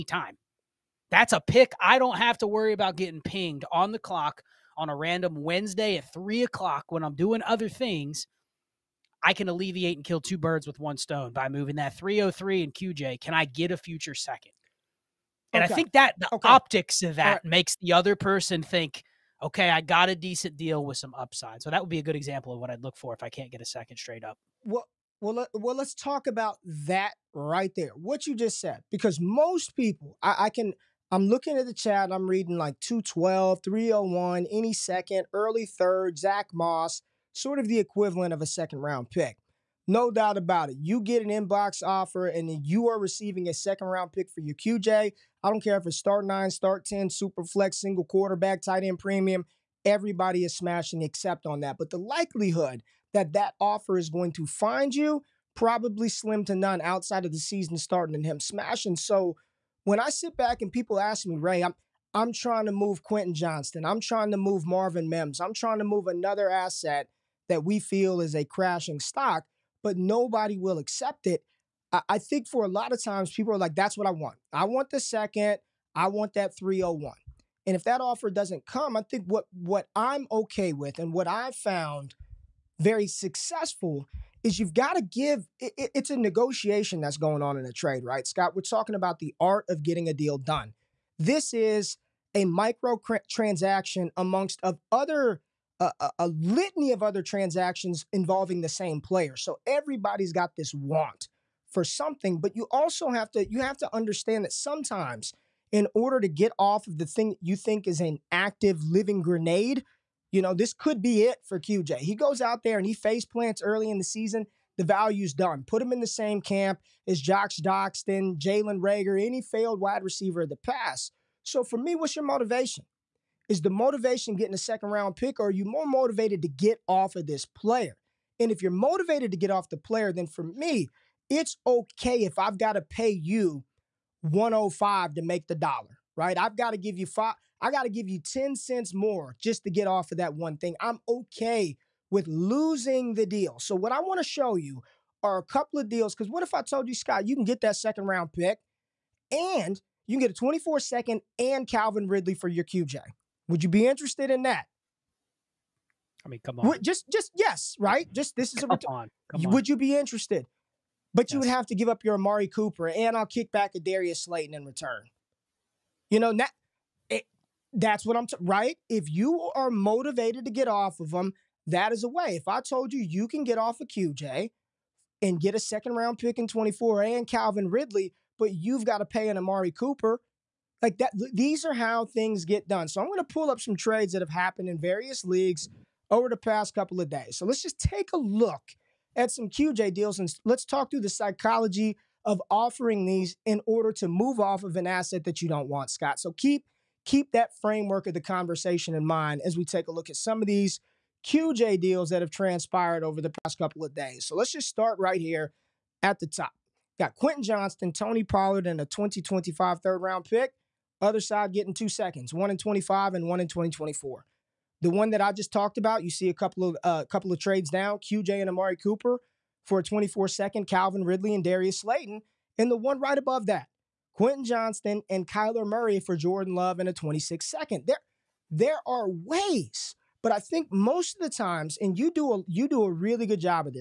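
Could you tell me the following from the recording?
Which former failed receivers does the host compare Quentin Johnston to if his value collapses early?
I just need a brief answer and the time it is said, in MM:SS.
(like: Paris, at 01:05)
Josh Doctson, at 01:57.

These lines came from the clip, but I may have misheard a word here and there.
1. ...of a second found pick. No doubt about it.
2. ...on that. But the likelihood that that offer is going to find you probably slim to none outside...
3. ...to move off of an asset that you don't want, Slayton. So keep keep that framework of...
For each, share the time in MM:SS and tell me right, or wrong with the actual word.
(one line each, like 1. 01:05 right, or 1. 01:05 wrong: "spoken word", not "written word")
1. 00:38 wrong: "round", not "found"
2. 00:51 right
3. 03:13 wrong: "Scott", not "Slayton".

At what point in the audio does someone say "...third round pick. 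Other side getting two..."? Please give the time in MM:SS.
03:29.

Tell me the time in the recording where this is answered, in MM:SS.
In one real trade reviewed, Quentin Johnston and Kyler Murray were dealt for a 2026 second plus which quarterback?
03:46.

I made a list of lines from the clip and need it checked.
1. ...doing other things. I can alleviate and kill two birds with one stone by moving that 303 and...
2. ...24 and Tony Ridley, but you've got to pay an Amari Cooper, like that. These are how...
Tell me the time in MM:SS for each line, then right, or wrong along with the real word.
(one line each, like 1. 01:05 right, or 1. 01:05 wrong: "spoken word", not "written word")
1. 00:07 right
2. 02:56 wrong: "Calvin", not "Tony".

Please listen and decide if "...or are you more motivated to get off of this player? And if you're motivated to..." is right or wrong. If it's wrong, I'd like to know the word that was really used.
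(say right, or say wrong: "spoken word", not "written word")
right.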